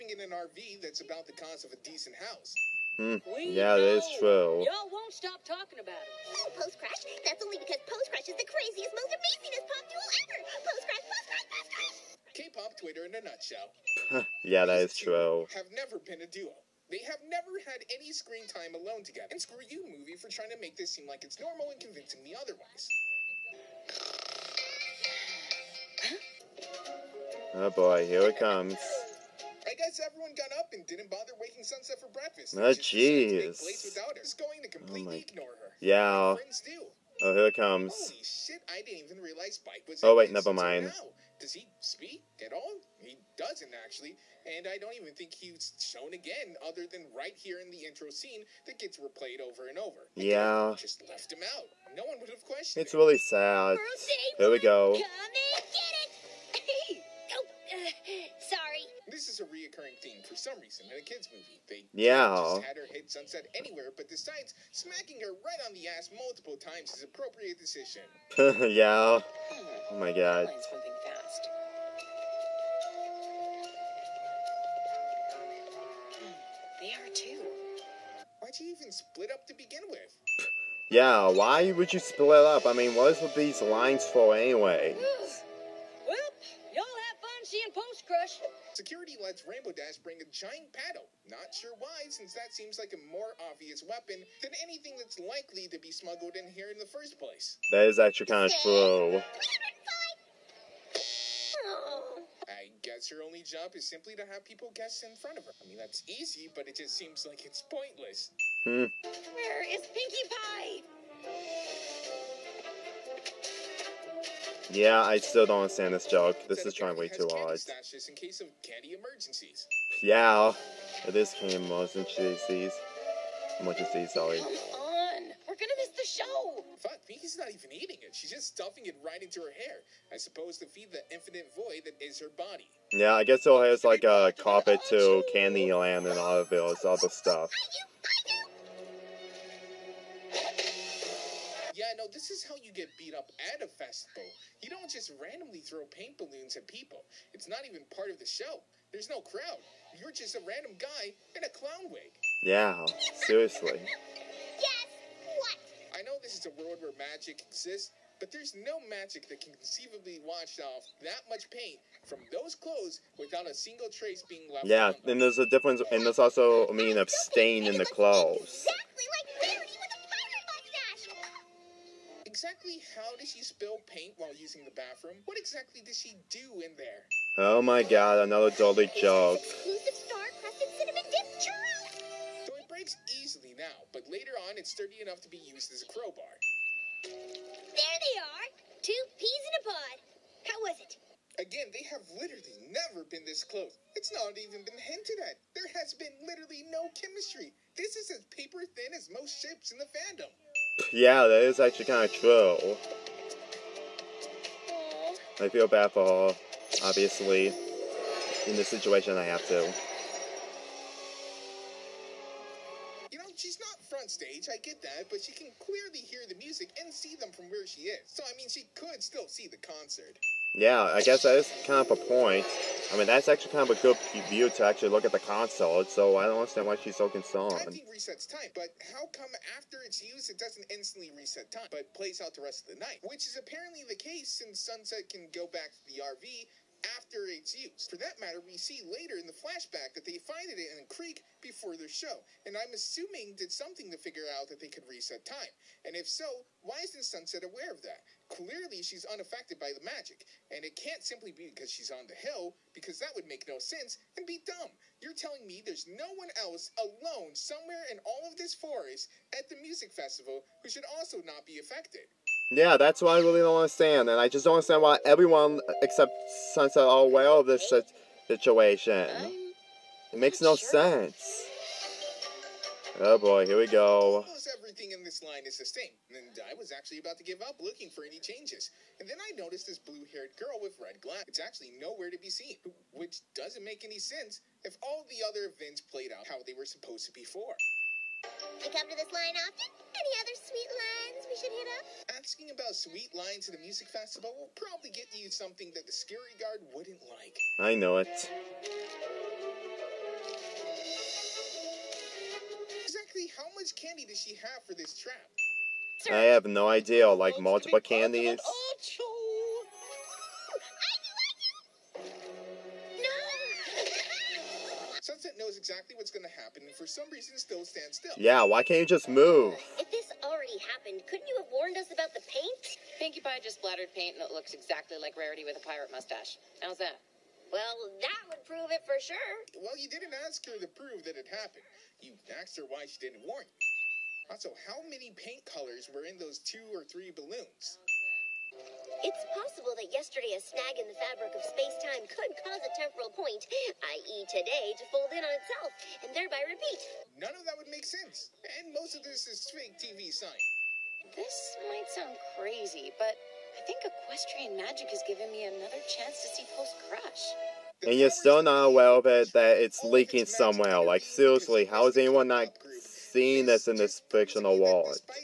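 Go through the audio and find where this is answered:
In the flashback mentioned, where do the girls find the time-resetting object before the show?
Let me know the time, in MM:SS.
04:00.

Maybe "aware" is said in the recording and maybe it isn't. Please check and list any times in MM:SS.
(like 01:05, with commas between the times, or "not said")
04:07, 04:27, 05:58.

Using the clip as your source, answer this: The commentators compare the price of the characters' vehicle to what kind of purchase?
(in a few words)
A decent house.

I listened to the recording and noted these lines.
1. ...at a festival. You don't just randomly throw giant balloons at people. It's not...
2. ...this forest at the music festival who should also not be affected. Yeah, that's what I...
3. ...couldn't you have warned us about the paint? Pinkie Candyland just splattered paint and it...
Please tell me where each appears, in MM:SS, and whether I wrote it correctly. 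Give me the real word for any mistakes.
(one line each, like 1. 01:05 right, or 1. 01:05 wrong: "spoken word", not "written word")
1. 02:23 wrong: "paint", not "giant"
2. 04:18 right
3. 05:21 wrong: "Pie", not "Candyland".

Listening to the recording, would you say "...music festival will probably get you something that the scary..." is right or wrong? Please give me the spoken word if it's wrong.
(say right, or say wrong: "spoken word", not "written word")
right.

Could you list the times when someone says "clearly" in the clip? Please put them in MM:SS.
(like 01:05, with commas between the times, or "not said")
03:35, 04:08.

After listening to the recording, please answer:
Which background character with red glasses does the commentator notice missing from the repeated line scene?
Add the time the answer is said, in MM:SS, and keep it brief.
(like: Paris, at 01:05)
Blue-haired girl, at 04:39.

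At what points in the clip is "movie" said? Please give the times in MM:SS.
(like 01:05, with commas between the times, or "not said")
00:19, 01:01.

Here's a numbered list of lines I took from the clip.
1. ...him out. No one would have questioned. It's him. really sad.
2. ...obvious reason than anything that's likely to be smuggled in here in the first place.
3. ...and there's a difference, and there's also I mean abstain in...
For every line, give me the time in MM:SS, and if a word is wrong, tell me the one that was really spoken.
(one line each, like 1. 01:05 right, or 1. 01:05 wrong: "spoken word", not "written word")
1. 00:51 right
2. 01:33 wrong: "weapon", not "reason"
3. 02:45 right.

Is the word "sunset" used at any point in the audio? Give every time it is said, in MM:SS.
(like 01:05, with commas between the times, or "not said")
00:31, 01:03, 03:54, 04:07, 04:26, 05:15.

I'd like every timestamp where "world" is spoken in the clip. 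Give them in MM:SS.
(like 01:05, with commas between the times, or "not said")
02:36, 06:04.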